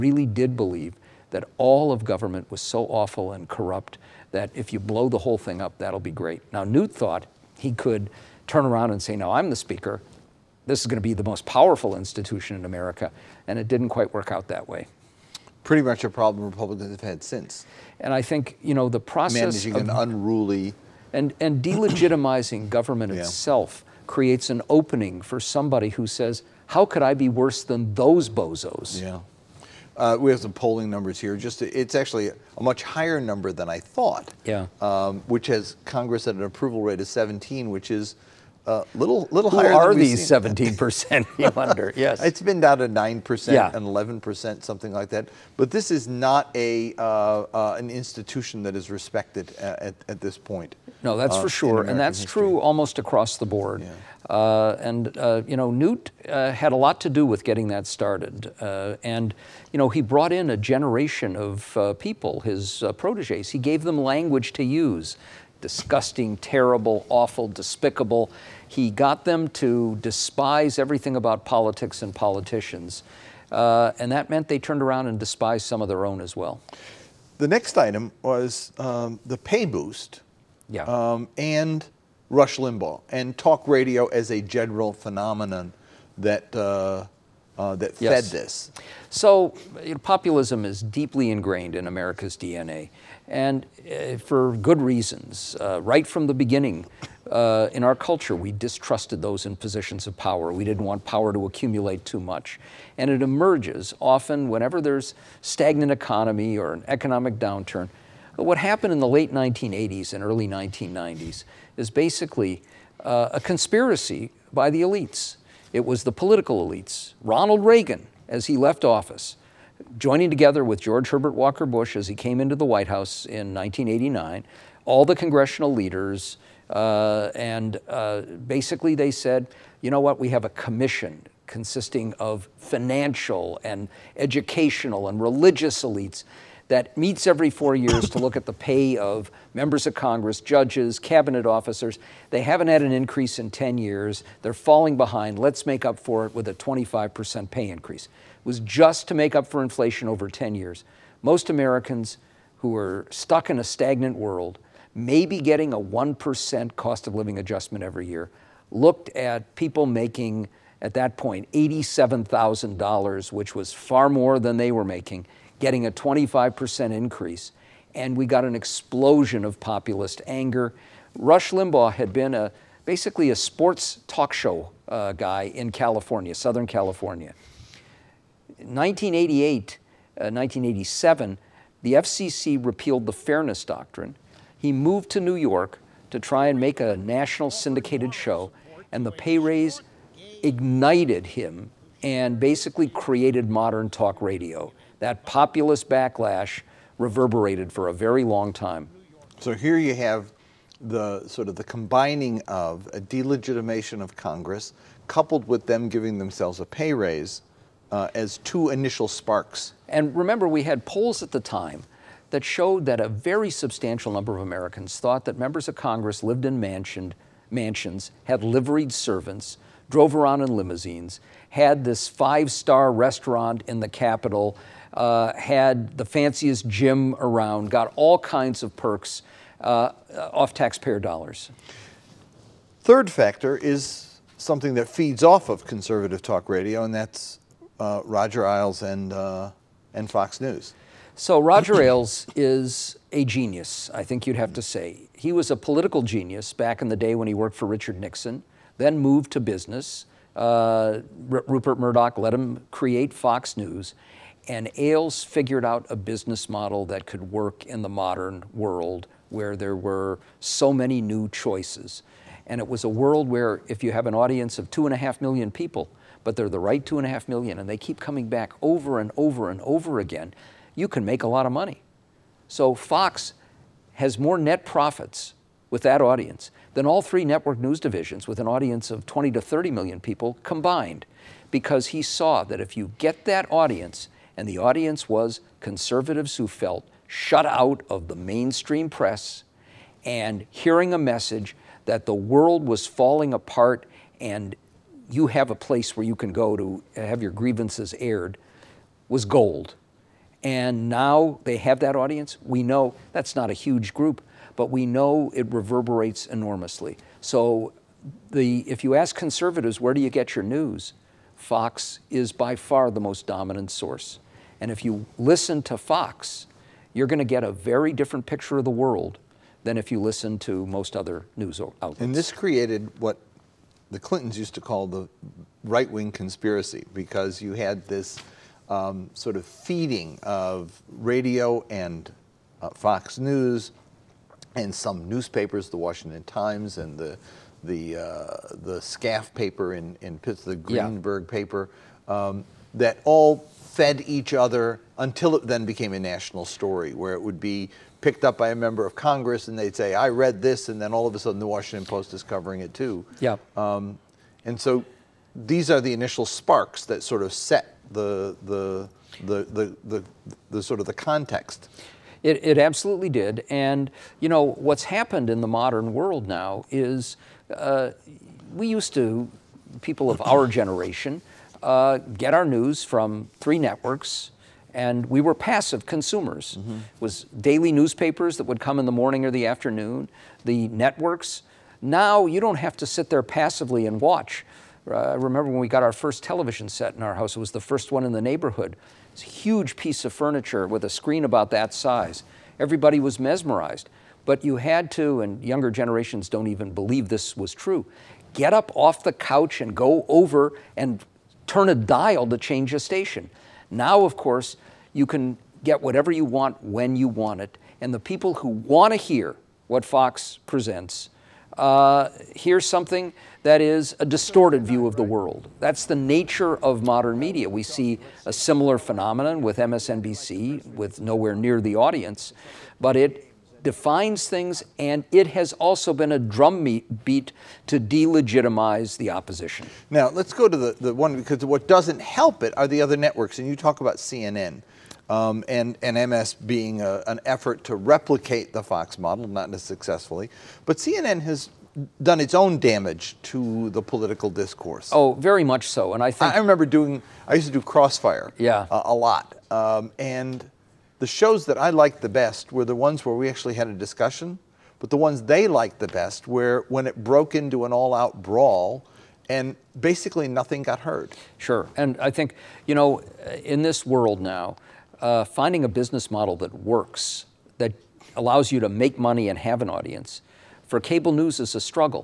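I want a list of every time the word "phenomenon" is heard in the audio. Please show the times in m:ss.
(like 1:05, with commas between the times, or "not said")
1:24, 6:58.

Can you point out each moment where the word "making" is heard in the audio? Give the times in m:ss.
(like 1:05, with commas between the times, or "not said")
2:39, 2:44.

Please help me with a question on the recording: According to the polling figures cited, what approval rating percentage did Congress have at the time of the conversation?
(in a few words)
17.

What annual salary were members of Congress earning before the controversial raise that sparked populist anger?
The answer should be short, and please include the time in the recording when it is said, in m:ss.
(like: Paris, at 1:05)
$87,000, at 2:41.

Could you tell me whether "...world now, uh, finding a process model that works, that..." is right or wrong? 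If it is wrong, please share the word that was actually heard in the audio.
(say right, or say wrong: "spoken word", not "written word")
wrong: "business", not "process".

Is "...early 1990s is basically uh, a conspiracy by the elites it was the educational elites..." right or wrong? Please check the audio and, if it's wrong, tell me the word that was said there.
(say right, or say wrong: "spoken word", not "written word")
wrong: "political", not "educational".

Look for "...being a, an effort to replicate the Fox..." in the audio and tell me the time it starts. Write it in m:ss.
7:16.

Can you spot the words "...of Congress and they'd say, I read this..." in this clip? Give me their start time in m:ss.
5:48.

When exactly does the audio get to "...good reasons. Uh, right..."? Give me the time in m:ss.
1:34.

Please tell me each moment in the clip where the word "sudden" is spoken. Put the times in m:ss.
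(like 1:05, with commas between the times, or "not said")
5:51.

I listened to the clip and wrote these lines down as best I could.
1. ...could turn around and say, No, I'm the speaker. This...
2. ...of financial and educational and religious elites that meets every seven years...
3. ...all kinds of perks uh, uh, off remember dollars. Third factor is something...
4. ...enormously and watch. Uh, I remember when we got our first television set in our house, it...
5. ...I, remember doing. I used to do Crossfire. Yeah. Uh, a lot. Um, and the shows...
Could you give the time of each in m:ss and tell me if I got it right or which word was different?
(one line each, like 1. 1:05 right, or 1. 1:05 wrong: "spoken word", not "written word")
1. 0:07 right
2. 2:12 wrong: "four", not "seven"
3. 3:47 wrong: "taxpayer", not "remember"
4. 6:23 wrong: "passively", not "enormously"
5. 7:26 right.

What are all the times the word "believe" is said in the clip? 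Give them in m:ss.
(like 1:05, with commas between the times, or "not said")
0:00, 6:36.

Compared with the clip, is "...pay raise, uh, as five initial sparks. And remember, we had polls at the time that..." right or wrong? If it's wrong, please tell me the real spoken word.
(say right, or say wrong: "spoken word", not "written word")
wrong: "two", not "five".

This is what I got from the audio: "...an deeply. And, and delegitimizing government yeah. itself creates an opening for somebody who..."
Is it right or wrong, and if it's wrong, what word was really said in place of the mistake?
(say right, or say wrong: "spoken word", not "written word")
wrong: "unruly", not "deeply".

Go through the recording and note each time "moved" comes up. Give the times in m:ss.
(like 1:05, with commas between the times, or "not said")
3:04, 4:08.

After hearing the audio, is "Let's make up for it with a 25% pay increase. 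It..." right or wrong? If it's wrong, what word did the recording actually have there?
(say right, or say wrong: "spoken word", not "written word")
right.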